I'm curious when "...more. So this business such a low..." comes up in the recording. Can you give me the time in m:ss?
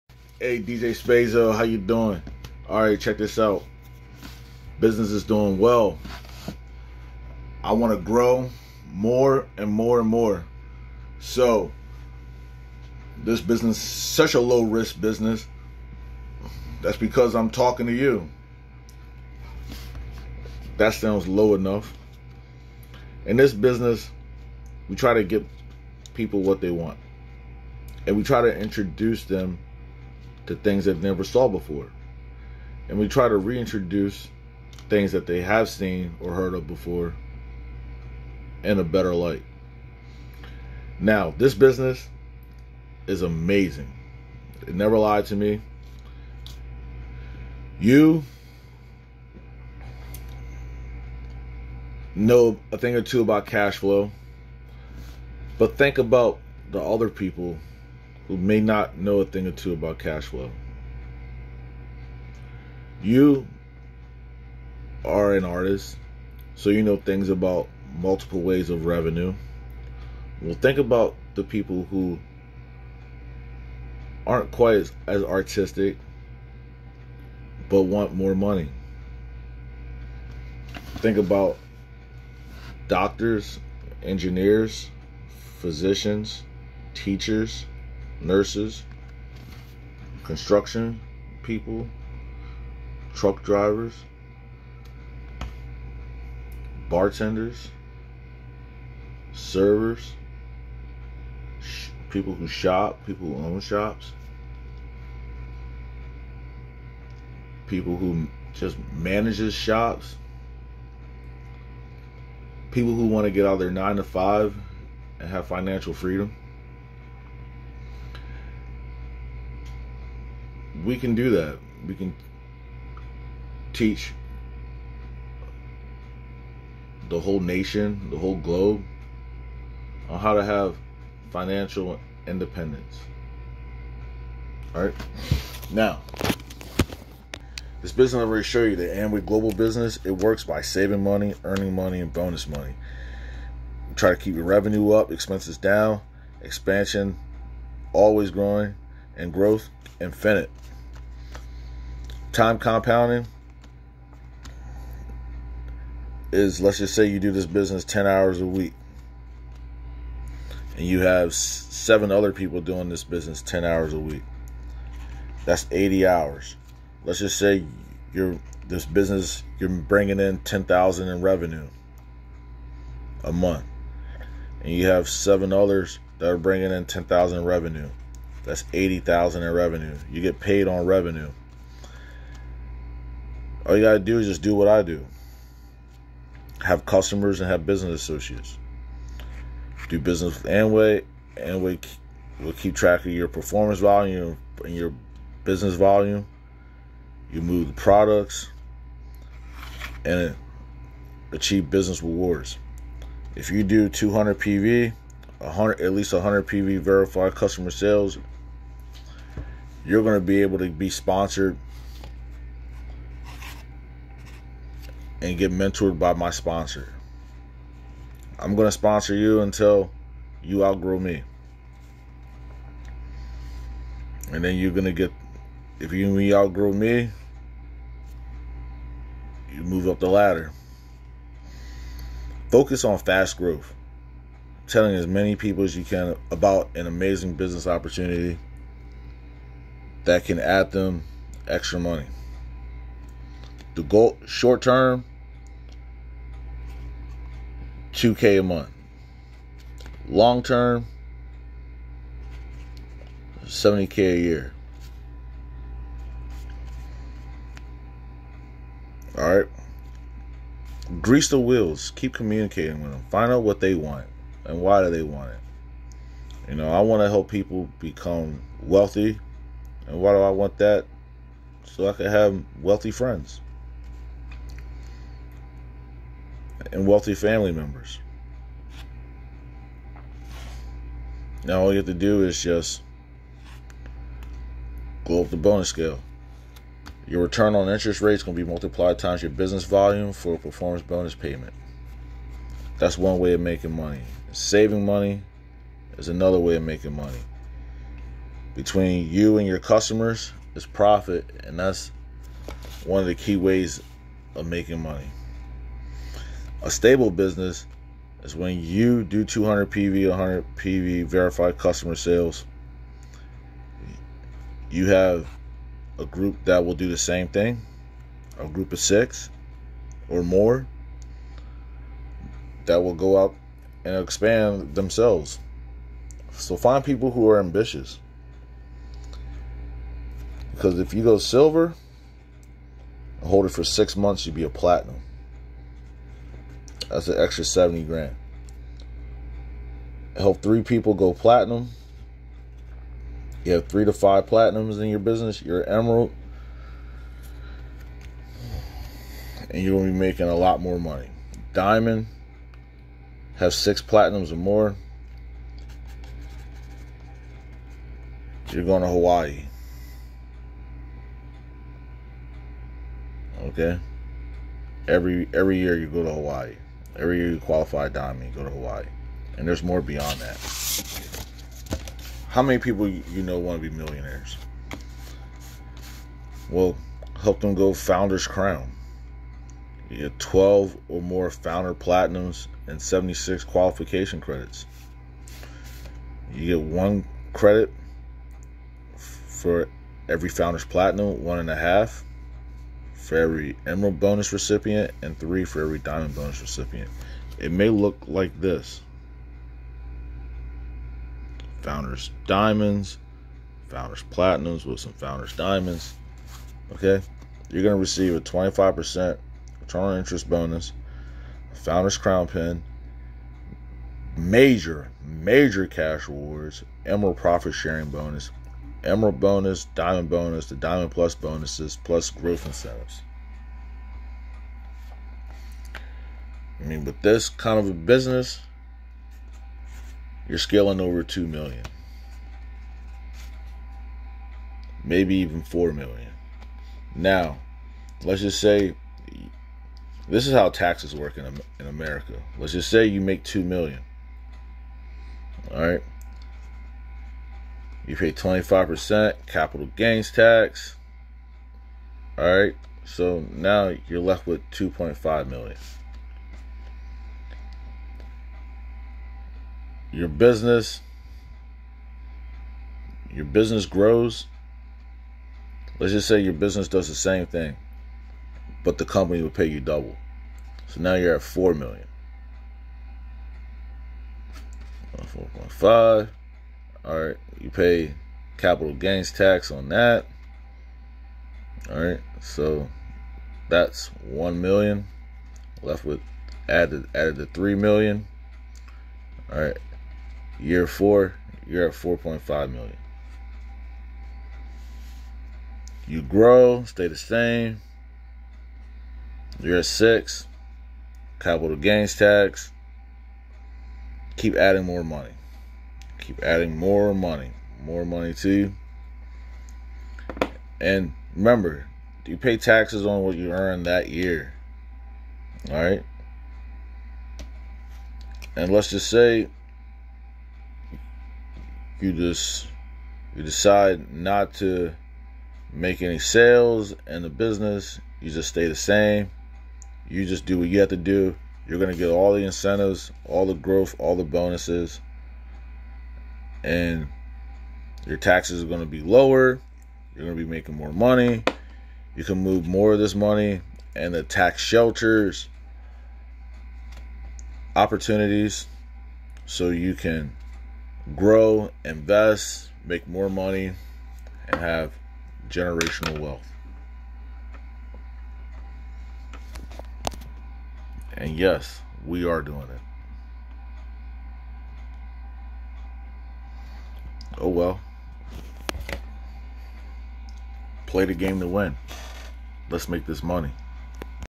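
0:10.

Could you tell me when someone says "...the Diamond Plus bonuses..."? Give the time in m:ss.
7:00.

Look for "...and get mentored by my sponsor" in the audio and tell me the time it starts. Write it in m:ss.
3:35.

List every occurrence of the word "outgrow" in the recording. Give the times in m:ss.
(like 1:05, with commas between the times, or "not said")
3:40, 3:46.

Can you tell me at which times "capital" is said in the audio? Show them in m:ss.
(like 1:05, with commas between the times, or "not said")
7:29, 7:58, 8:21.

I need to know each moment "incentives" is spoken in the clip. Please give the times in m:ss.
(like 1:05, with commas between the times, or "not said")
7:02, 8:52.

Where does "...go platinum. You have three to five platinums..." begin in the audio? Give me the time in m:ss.
5:40.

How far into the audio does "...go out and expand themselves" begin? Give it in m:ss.
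5:22.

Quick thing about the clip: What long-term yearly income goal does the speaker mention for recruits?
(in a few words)
70k a year.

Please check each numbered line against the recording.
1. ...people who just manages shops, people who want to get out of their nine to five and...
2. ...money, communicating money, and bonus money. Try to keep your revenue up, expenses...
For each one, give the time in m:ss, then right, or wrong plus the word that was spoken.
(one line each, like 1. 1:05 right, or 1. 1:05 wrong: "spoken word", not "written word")
1. 1:47 right
2. 2:21 wrong: "earning", not "communicating".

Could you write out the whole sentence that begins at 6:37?
It may look like this Founders Diamonds, Founders Platinums with some Founders Diamonds.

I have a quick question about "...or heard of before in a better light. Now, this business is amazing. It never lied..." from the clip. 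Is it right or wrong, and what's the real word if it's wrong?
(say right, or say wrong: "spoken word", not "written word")
right.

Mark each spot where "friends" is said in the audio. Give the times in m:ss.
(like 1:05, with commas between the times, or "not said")
4:32.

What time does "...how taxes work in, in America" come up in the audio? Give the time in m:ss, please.
7:20.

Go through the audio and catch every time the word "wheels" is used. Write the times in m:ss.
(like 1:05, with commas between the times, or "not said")
4:21.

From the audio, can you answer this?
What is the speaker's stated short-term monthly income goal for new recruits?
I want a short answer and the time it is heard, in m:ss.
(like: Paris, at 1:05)
2k a month, at 4:07.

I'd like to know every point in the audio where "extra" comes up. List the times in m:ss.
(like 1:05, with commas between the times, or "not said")
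4:01, 5:37.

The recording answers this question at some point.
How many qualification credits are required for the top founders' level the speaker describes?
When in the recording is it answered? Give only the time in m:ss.
6:22.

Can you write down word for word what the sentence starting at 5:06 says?
A stable business is when you do 200 PV, 100 PV verified customer sales.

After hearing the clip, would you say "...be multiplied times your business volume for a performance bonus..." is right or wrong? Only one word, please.
right.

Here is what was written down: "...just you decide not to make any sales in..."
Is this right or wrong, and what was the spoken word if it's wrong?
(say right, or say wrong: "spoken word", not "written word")
right.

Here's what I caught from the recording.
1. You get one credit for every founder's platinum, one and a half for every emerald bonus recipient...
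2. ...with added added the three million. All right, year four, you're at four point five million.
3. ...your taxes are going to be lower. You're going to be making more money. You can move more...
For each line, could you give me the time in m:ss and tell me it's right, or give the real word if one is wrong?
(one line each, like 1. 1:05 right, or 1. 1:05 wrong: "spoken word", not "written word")
1. 6:26 right
2. 8:05 right
3. 8:57 right.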